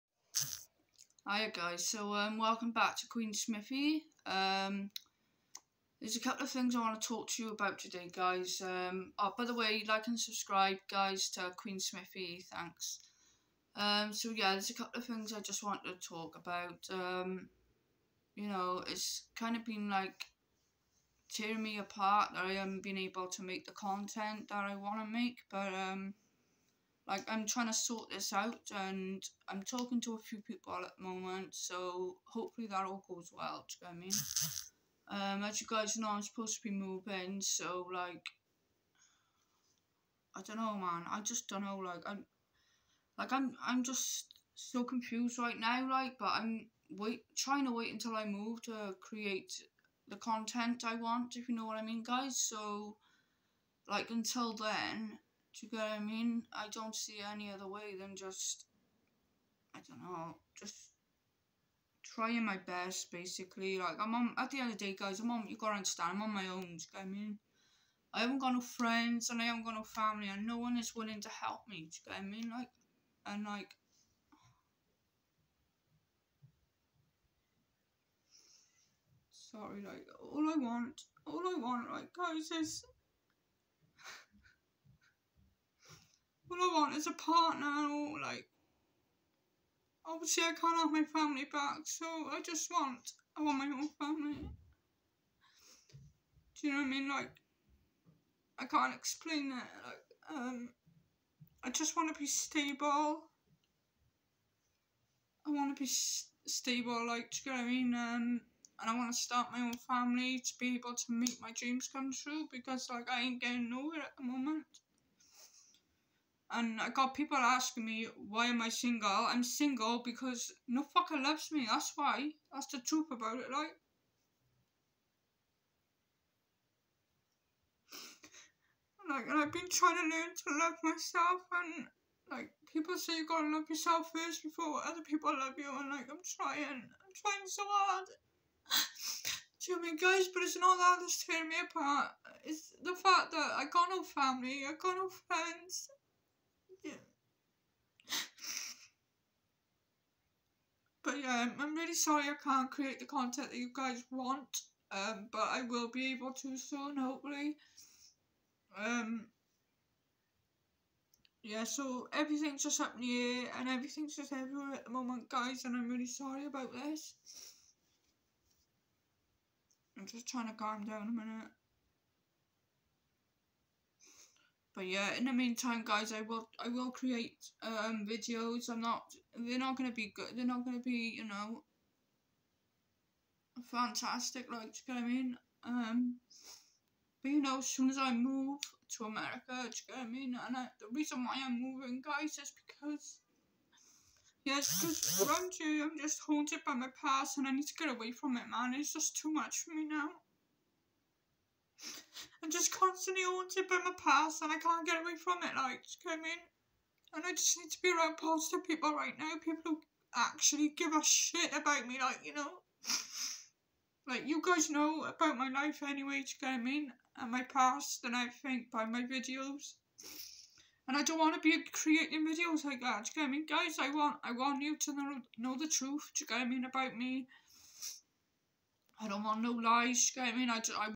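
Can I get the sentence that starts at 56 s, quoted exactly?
I don't see any other way than just, I don't know, just trying my best, basically.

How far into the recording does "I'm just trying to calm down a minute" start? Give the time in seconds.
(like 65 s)
169 s.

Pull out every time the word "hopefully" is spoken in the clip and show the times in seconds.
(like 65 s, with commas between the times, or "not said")
32 s, 156 s.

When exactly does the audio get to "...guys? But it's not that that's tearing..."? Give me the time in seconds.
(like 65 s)
139 s.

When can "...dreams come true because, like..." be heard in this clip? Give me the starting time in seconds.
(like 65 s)
111 s.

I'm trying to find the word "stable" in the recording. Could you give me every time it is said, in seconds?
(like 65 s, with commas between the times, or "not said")
102 s, 106 s.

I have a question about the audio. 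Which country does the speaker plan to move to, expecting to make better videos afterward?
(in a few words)
America.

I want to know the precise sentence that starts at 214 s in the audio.
like, you guys know about my life anyway, do you get what I mean?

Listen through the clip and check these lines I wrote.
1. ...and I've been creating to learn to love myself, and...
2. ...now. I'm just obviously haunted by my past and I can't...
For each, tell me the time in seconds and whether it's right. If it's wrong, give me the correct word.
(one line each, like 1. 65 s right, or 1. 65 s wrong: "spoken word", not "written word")
1. 129 s wrong: "trying", not "creating"
2. 199 s wrong: "constantly", not "obviously".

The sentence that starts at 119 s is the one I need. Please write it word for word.
I'm single because no fucker loves me.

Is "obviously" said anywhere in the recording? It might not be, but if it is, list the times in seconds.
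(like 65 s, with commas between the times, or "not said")
90 s.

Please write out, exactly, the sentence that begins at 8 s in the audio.
Um, oh, by the way, like and subscribe, guys, to Queen Smithy.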